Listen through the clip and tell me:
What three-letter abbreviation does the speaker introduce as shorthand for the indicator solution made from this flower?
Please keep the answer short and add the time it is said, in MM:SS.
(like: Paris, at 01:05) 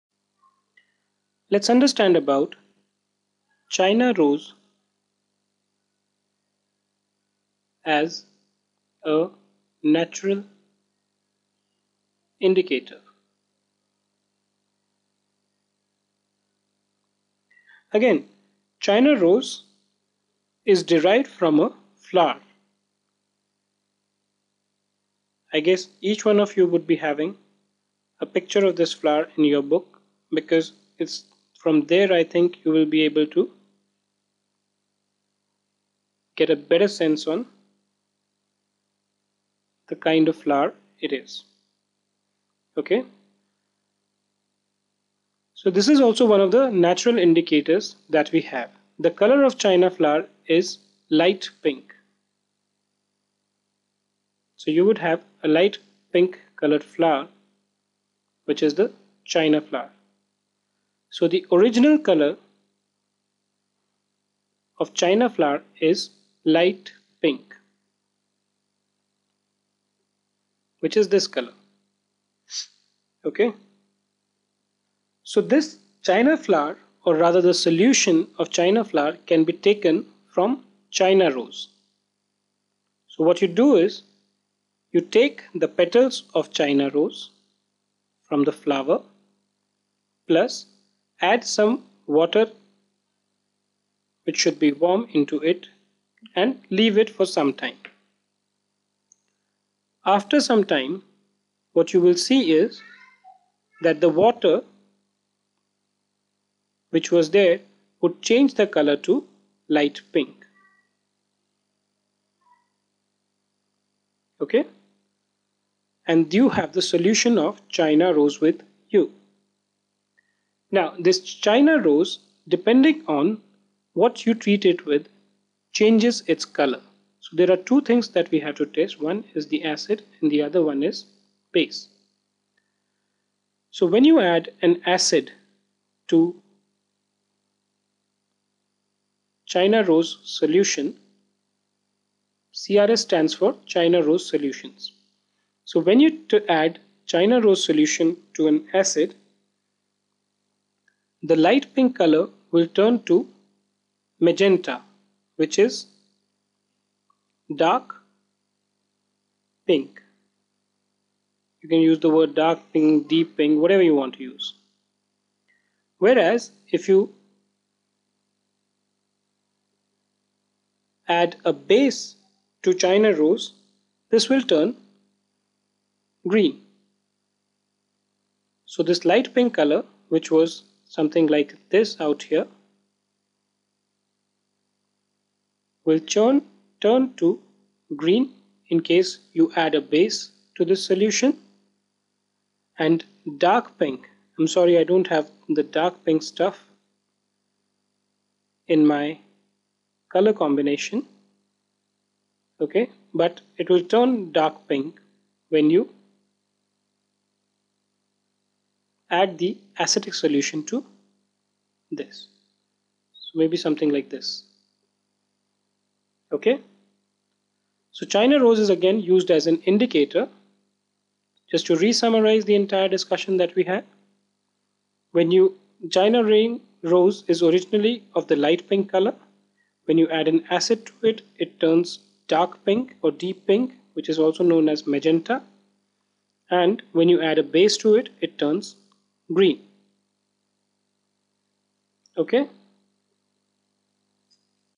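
CRS, at 02:22.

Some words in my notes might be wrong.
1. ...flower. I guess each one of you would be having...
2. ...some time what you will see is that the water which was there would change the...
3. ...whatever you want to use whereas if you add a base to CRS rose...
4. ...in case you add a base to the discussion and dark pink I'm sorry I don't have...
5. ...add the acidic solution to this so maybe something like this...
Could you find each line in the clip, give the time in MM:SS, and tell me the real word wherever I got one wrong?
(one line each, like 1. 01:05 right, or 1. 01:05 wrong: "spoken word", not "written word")
1. 00:21 right
2. 01:40 right
3. 02:43 wrong: "China", not "CRS"
4. 03:08 wrong: "solution", not "discussion"
5. 03:29 right.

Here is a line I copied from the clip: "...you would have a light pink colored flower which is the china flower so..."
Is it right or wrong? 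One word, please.
right.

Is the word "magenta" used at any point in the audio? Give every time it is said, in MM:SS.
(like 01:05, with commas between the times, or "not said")
02:34, 03:54.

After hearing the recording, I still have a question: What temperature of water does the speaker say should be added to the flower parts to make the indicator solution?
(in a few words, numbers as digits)
Warm.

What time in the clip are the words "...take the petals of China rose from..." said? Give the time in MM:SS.
01:25.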